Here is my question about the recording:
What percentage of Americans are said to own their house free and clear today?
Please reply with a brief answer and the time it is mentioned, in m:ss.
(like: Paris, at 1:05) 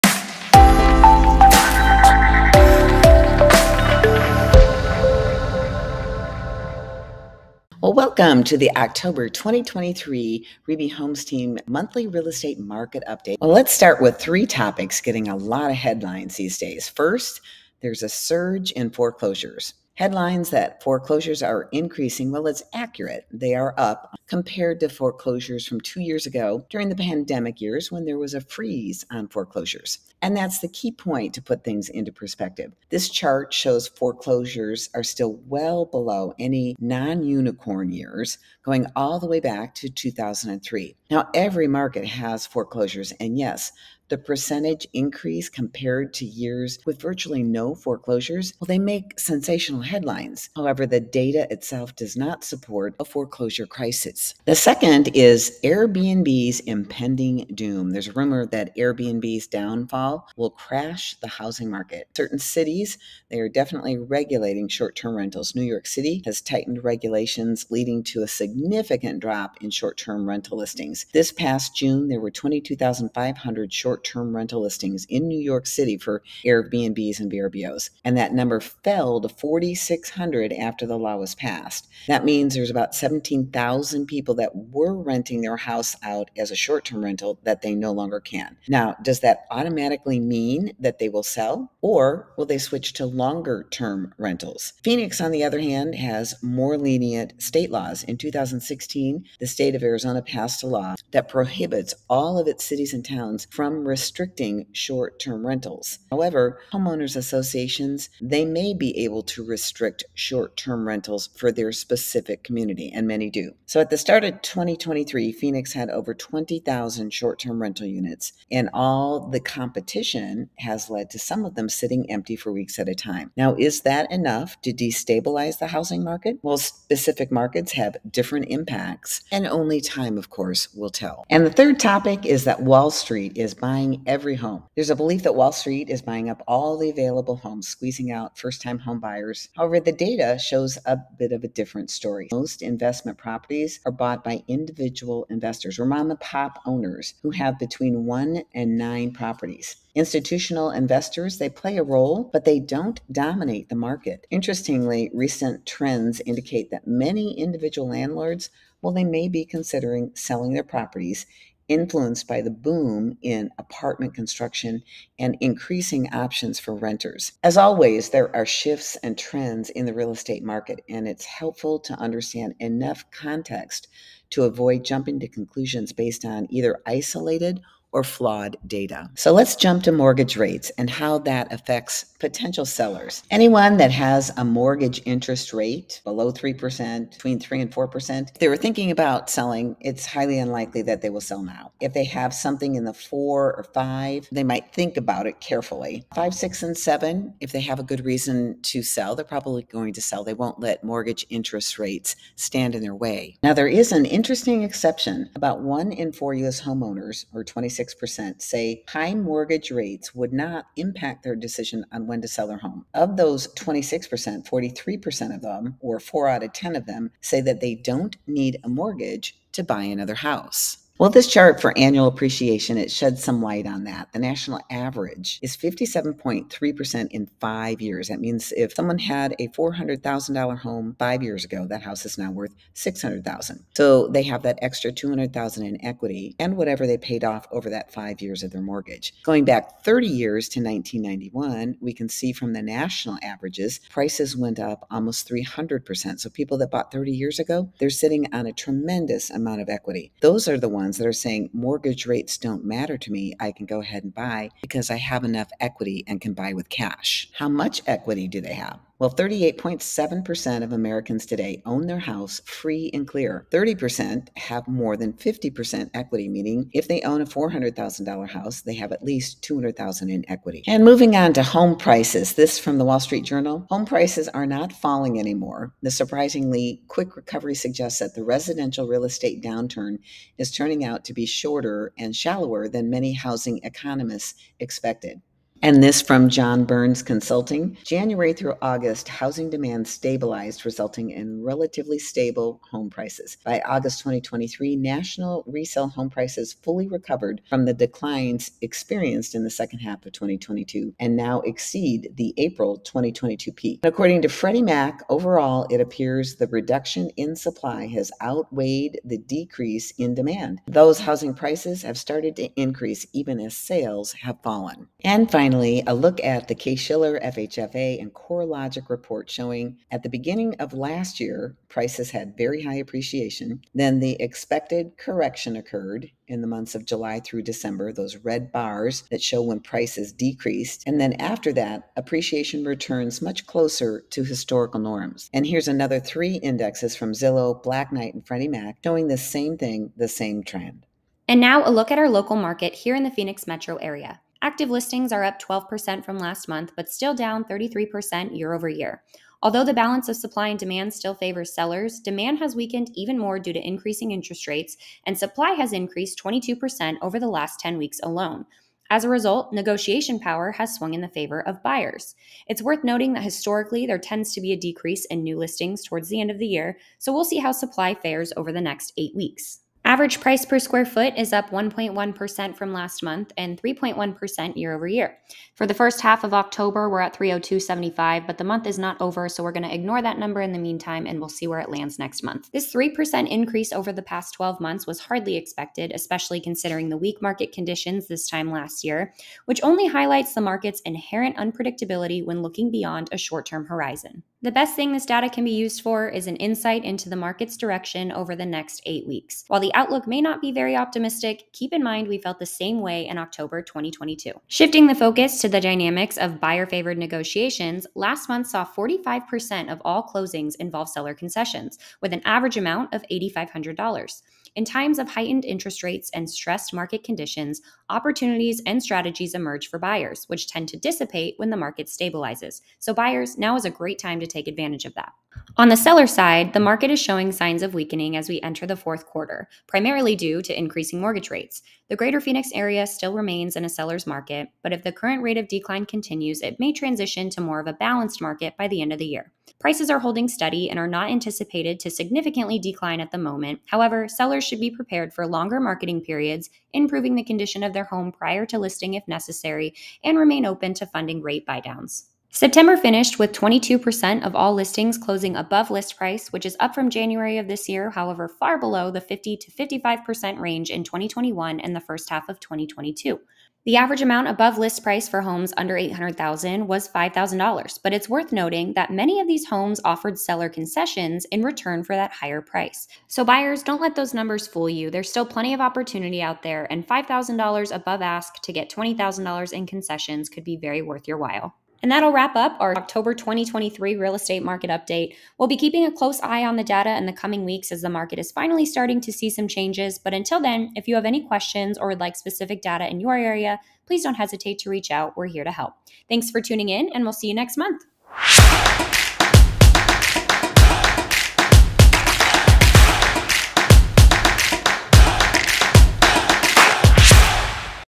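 38.7%, at 4:19.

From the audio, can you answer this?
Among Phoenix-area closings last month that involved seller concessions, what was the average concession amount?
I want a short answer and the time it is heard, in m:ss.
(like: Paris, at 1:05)
$8,500, at 6:53.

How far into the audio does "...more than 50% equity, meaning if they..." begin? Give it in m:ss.
4:24.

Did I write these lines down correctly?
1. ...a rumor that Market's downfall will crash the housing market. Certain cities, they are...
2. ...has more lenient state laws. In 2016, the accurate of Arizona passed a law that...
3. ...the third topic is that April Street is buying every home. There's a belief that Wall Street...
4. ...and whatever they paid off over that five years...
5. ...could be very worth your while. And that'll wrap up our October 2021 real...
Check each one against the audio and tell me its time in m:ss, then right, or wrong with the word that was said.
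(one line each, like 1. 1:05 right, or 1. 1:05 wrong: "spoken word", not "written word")
1. 0:58 wrong: "Airbnb", not "Market"
2. 1:35 wrong: "state", not "accurate"
3. 2:11 wrong: "Wall", not "April"
4. 3:56 right
5. 8:00 wrong: "2023", not "2021".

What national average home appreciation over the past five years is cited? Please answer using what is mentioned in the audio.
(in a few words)
57.3%.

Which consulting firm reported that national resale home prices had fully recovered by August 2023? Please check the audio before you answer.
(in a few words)
John Burns Consulting.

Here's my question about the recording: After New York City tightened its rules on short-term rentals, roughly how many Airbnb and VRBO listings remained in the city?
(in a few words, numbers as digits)
4,600.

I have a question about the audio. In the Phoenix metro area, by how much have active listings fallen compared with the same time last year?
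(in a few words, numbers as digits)
33%.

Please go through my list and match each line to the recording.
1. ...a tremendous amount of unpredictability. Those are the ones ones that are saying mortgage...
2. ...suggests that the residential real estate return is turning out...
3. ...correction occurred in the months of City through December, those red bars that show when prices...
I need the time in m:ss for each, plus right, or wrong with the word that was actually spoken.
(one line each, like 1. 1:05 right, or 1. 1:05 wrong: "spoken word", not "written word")
1. 4:08 wrong: "equity", not "unpredictability"
2. 4:37 wrong: "downturn", not "return"
3. 5:24 wrong: "July", not "City".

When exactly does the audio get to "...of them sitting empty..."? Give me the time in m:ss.
2:01.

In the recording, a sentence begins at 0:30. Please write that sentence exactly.
And that's the key point to put things into perspective.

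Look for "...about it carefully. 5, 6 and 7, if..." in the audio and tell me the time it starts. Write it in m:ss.
3:14.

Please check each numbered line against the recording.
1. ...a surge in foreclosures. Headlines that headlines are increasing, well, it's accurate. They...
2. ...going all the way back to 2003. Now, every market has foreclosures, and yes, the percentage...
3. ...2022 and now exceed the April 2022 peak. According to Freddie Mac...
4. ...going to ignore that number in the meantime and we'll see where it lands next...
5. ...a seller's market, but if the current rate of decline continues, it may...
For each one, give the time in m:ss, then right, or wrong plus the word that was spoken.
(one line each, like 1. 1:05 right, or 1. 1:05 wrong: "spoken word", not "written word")
1. 0:18 wrong: "foreclosures", not "headlines"
2. 0:38 right
3. 5:00 right
4. 6:19 right
5. 7:13 right.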